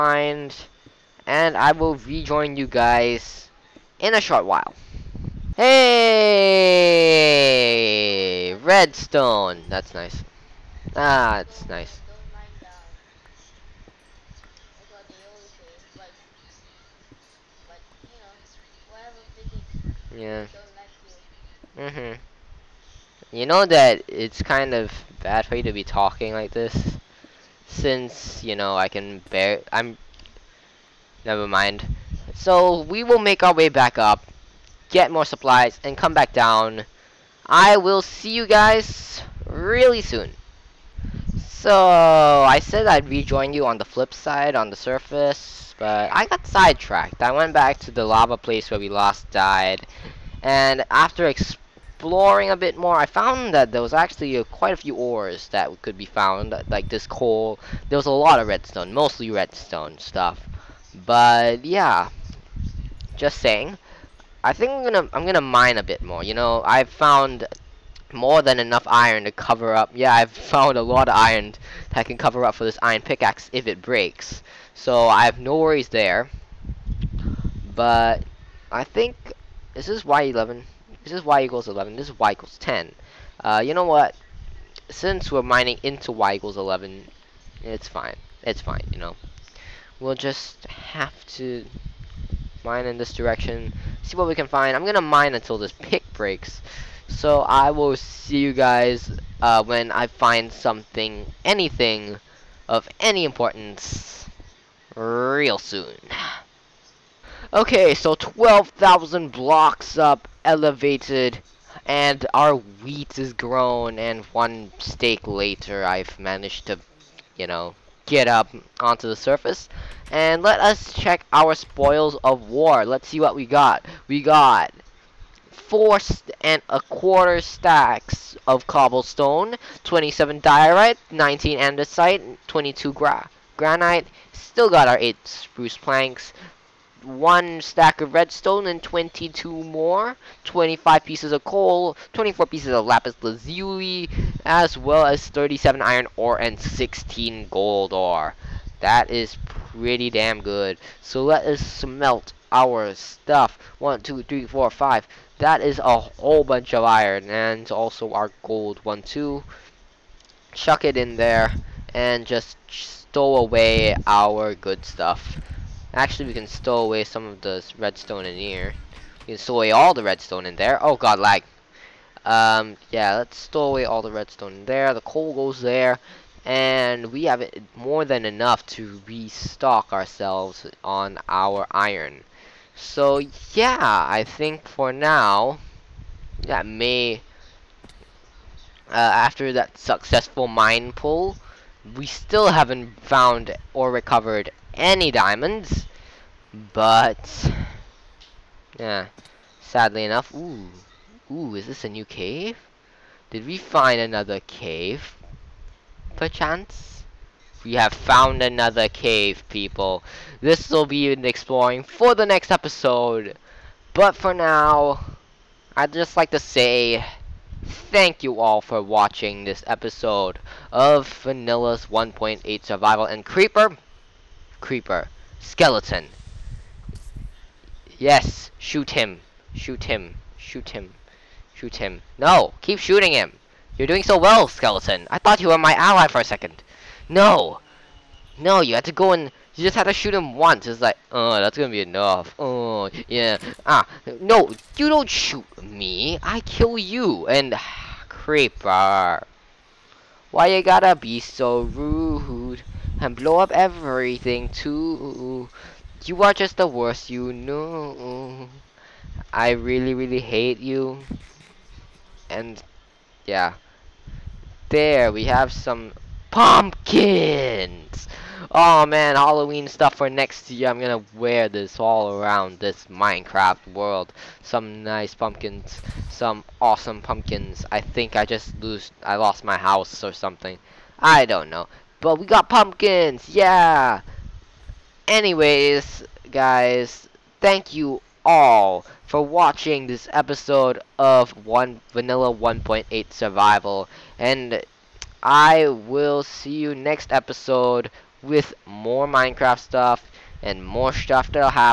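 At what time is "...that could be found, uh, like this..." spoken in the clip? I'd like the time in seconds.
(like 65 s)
55 s.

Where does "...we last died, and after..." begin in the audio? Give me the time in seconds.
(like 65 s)
48 s.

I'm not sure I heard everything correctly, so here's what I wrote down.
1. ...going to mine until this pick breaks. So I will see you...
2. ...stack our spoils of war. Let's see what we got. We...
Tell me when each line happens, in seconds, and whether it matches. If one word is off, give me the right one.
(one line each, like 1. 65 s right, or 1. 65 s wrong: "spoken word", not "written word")
1. 94 s right
2. 120 s wrong: "check", not "stack".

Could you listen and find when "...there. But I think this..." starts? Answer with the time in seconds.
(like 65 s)
75 s.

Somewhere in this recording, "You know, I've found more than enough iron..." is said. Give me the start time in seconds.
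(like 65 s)
66 s.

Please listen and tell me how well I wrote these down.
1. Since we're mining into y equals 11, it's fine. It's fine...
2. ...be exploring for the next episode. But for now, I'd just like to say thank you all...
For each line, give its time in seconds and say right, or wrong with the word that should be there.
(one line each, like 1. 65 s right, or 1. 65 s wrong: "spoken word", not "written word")
1. 84 s right
2. 210 s right.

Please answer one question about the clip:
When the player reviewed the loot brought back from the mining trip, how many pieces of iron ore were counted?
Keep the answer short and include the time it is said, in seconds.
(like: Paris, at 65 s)
37, at 145 s.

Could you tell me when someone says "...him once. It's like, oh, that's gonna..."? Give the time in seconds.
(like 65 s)
240 s.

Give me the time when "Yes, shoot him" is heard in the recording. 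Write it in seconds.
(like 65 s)
227 s.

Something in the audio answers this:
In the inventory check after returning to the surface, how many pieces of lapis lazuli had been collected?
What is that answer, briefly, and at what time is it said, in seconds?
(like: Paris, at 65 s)
24, at 142 s.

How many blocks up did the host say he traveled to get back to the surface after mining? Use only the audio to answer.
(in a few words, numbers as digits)
12,000.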